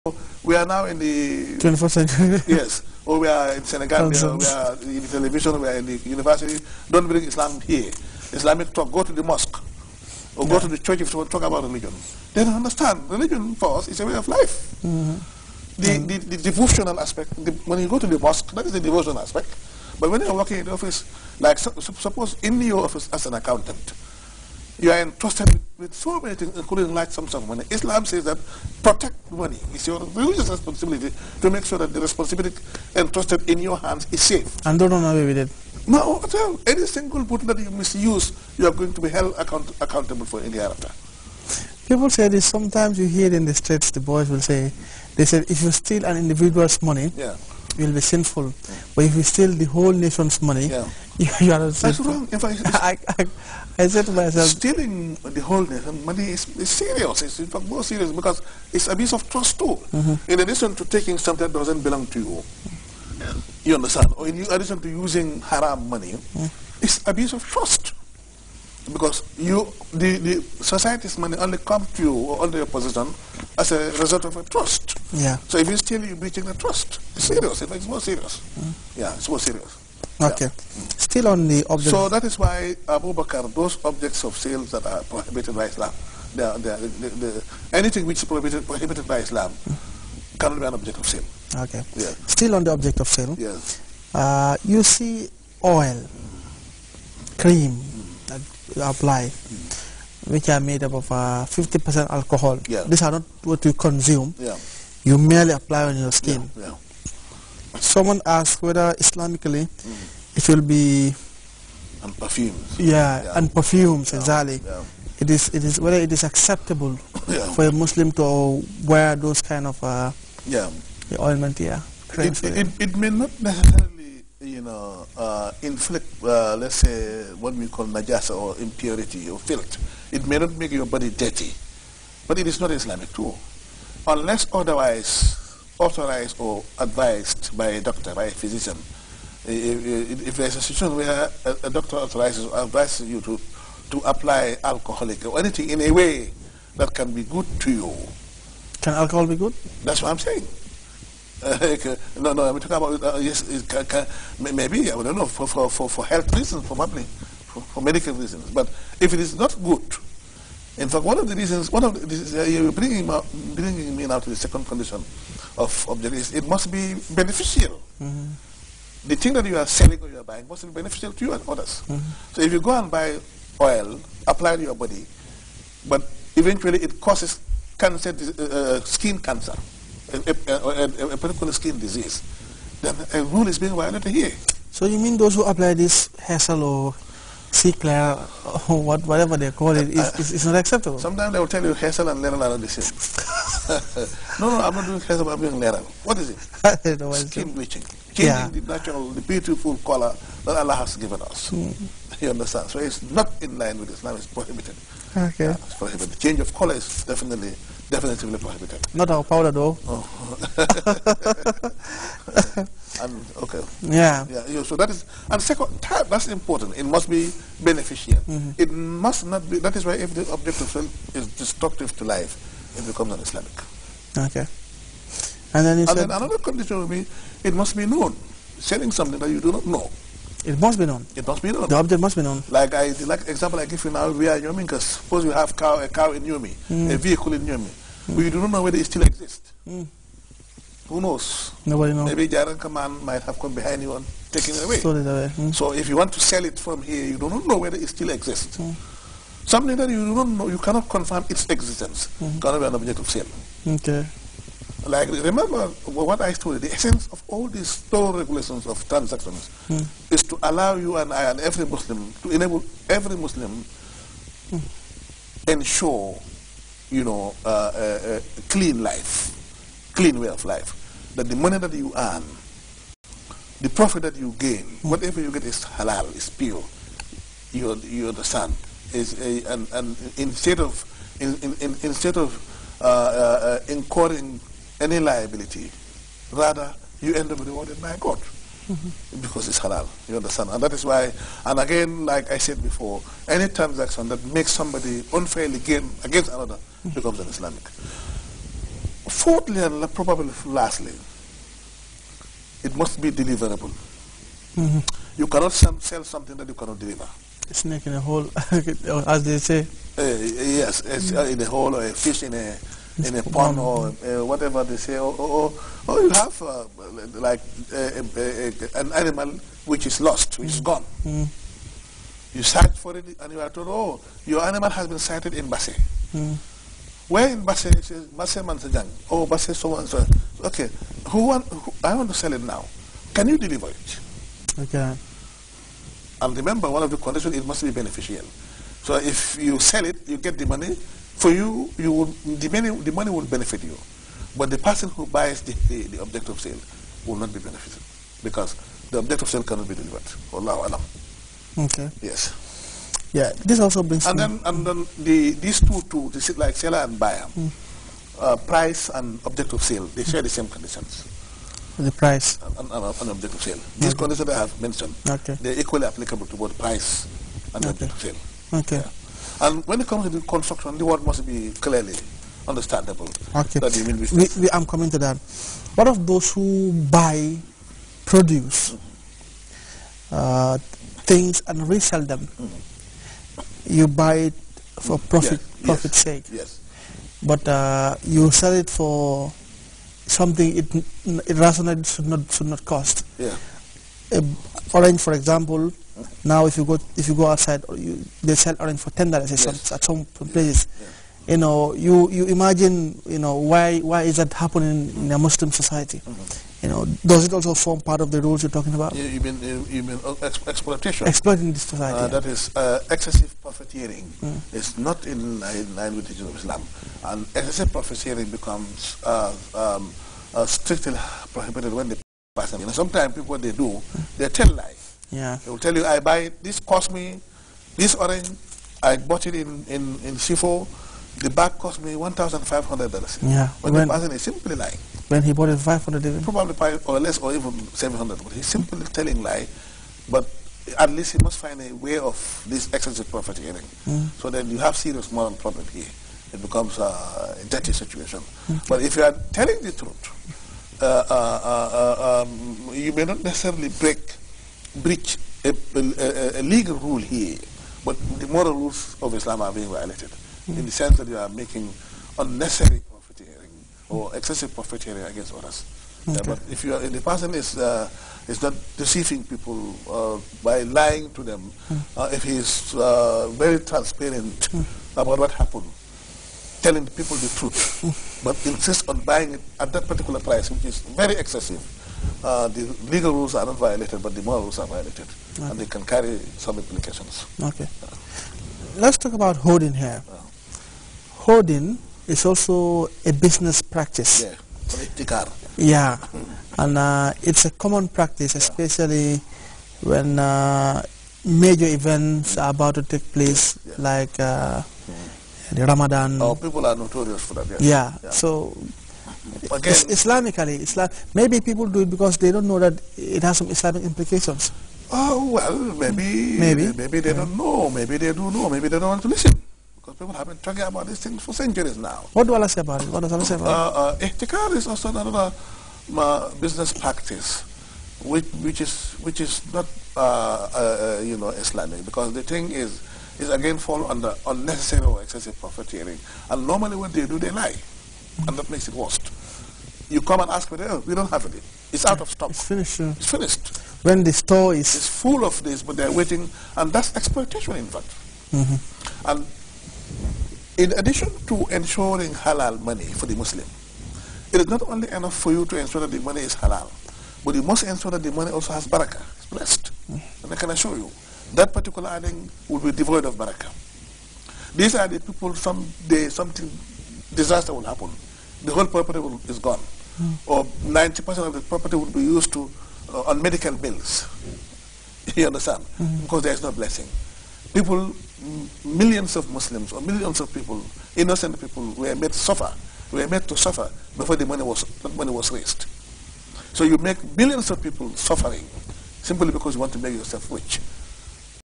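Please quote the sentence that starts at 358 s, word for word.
uh, price and object of sale, they share the same conditions the price?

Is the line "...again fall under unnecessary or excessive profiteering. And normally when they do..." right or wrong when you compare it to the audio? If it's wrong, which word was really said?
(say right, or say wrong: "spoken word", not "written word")
right.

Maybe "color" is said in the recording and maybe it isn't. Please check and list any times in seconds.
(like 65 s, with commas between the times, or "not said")
199 s, 206 s.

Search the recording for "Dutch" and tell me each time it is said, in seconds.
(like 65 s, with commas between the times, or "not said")
not said.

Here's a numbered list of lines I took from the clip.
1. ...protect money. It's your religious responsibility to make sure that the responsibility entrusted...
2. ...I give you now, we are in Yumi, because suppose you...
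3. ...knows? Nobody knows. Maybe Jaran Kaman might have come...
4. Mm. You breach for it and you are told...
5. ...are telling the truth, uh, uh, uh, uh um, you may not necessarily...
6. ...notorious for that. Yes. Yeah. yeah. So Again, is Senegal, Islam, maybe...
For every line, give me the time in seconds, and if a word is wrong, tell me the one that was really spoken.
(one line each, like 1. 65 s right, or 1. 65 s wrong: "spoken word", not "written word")
1. 28 s right
2. 233 s right
3. 241 s right
4. 321 s wrong: "search", not "breach"
5. 449 s right
6. 506 s wrong: "Islamically", not "Senegal".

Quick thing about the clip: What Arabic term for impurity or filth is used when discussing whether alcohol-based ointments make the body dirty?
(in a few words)
najasa.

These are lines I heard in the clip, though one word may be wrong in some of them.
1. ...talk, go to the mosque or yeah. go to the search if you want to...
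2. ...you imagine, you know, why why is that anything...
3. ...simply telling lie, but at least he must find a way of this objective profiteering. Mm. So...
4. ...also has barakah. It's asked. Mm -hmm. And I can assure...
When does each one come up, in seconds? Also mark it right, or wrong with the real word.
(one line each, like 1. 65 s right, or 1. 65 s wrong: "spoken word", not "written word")
1. 8 s wrong: "church", not "search"
2. 402 s wrong: "happening", not "anything"
3. 438 s wrong: "excessive", not "objective"
4. 558 s wrong: "blessed", not "asked".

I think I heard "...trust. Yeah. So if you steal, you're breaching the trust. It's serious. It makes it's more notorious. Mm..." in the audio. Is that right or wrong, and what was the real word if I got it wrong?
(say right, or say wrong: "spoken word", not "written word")
wrong: "serious", not "notorious".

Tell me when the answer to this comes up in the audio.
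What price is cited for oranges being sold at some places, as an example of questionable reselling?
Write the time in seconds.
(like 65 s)
398 s.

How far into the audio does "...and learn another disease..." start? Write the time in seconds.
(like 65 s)
192 s.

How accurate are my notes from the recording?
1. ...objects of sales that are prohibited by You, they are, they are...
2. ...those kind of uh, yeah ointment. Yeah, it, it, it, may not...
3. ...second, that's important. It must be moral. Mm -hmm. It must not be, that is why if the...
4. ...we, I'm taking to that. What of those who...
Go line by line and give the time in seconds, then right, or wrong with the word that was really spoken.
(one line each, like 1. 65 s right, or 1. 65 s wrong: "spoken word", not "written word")
1. 83 s wrong: "Islam", not "You"
2. 119 s right
3. 215 s wrong: "beneficial", not "moral"
4. 374 s wrong: "coming", not "taking".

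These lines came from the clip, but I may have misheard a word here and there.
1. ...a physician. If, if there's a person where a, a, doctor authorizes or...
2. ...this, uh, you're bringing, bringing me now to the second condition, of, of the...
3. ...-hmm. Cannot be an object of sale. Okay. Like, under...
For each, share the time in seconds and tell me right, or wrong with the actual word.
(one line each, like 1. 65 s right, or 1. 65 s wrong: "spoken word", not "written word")
1. 138 s wrong: "situation", not "person"
2. 162 s right
3. 252 s wrong: "remember", not "under".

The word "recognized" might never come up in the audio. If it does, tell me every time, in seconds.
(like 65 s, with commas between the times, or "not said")
not said.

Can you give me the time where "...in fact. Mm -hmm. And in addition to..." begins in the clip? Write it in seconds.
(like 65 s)
547 s.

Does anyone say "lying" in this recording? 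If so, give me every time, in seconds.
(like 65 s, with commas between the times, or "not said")
434 s, 470 s.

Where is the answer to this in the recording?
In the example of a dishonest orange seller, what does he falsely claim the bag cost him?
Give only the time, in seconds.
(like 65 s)
431 s.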